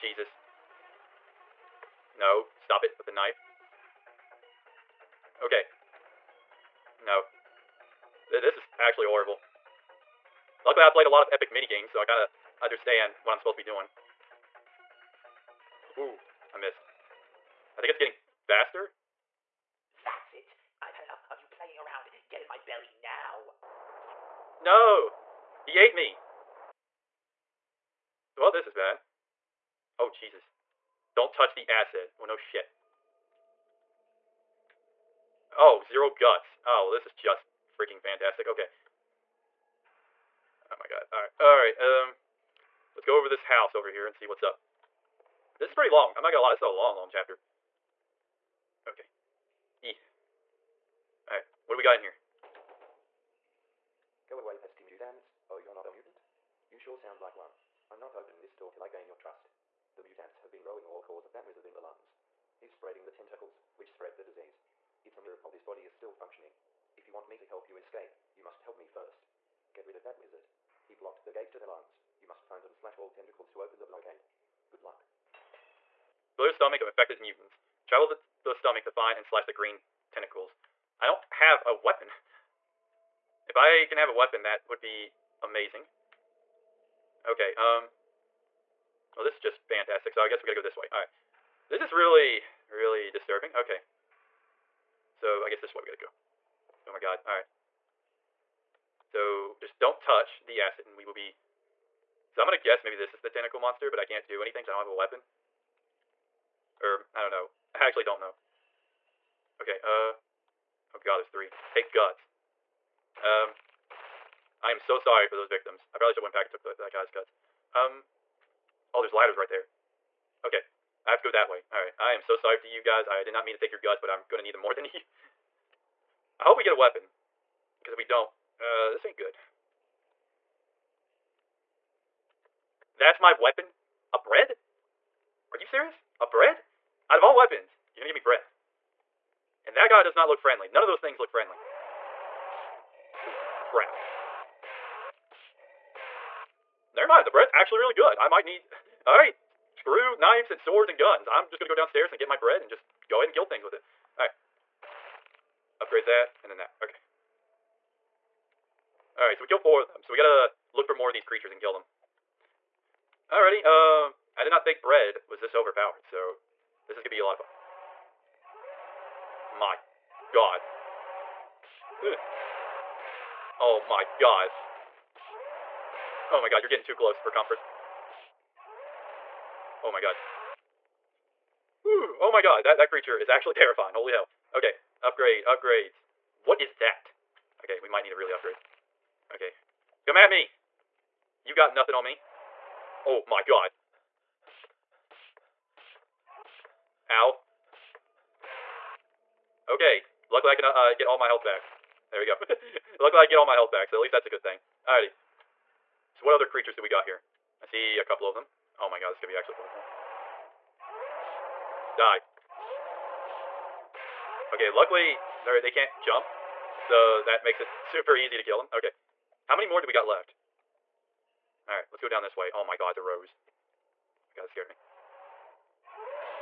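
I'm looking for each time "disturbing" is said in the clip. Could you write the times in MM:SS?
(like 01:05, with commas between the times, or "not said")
01:33.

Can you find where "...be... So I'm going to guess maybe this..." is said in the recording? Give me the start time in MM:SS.
01:41.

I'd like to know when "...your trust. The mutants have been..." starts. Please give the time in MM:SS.
00:59.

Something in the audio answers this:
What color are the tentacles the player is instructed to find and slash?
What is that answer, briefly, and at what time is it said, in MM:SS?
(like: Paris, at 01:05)
Green, at 01:19.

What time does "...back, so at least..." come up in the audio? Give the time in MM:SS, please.
03:23.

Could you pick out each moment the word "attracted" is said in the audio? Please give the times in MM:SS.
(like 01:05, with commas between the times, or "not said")
not said.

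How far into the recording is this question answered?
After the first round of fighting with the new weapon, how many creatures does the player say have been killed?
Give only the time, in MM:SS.
02:39.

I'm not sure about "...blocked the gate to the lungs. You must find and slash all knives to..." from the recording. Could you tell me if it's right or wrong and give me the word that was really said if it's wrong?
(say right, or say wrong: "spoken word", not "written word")
wrong: "tentacles", not "knives".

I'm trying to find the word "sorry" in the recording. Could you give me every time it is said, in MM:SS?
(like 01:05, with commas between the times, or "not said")
01:54, 02:02.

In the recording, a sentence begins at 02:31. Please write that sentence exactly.
I'm just going to go downstairs and get my bread and just go ahead and kill things with it.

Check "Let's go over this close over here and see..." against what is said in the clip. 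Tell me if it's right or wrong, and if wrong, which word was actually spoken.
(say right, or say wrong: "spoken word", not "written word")
wrong: "house", not "close".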